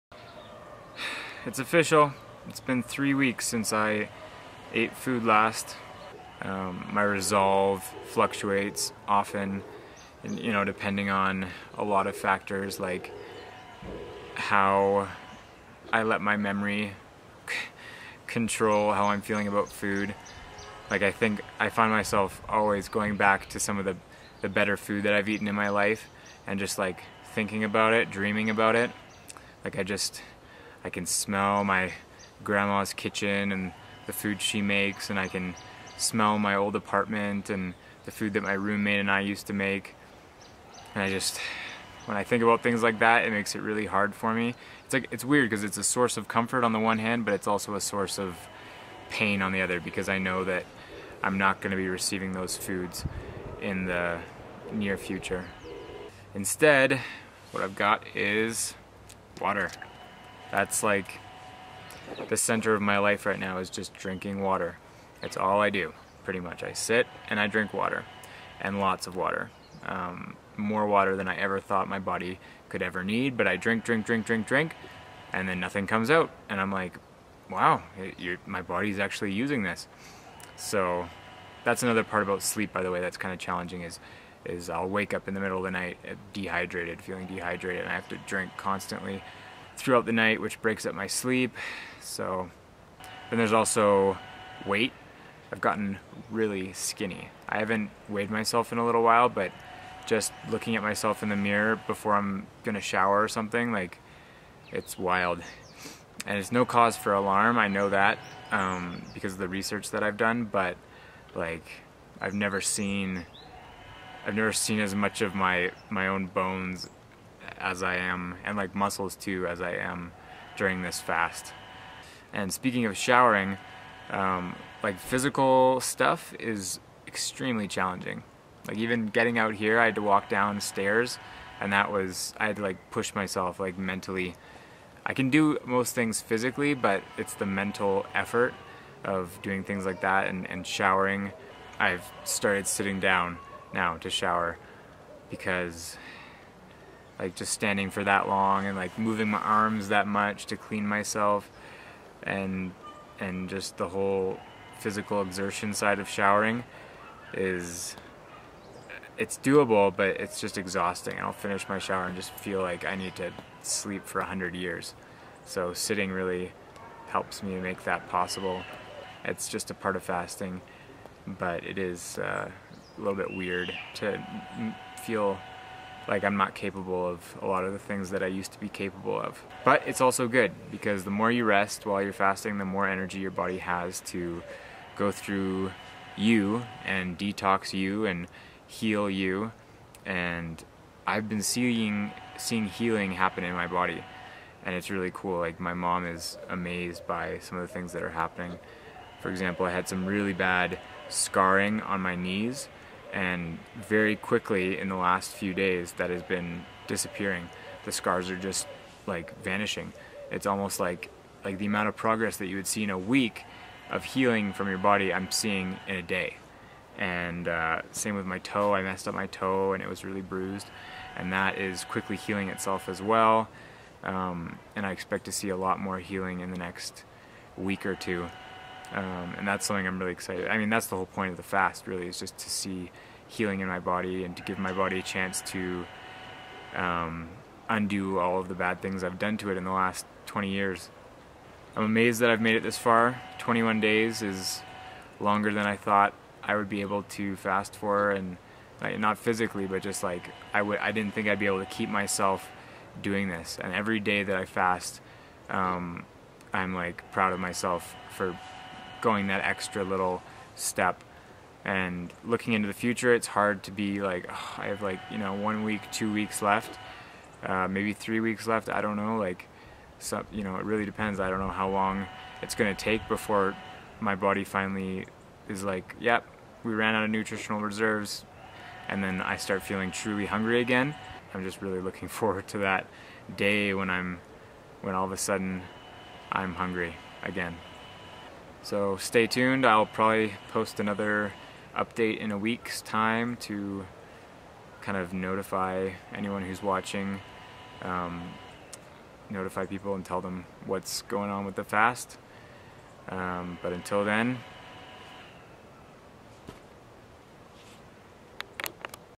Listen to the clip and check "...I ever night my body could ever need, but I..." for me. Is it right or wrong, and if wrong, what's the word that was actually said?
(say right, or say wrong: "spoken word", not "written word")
wrong: "thought", not "night".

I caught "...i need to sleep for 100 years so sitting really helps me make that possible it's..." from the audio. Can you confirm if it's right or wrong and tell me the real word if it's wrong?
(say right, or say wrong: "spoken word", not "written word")
right.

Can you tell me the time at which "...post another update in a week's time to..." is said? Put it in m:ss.
4:50.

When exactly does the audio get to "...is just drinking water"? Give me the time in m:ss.
1:03.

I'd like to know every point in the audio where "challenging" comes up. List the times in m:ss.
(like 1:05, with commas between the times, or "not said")
1:23, 2:07.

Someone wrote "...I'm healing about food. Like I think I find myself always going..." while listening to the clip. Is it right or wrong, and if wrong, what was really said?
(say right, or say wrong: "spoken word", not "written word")
wrong: "feeling", not "healing".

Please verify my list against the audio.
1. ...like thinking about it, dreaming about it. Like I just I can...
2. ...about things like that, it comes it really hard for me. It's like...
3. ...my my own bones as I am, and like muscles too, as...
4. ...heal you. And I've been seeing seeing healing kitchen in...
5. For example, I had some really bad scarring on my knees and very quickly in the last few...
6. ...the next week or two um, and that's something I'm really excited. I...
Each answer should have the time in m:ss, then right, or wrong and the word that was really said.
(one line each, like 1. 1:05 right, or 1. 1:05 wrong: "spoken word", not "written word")
1. 0:26 right
2. 0:42 wrong: "makes", not "comes"
3. 1:55 right
4. 3:08 wrong: "happen", not "kitchen"
5. 3:19 right
6. 3:46 right.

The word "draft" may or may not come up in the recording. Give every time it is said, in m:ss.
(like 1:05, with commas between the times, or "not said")
not said.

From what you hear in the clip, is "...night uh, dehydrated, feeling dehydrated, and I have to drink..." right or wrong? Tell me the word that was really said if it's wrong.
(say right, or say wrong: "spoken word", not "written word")
right.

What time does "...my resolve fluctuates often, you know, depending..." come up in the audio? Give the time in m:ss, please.
0:06.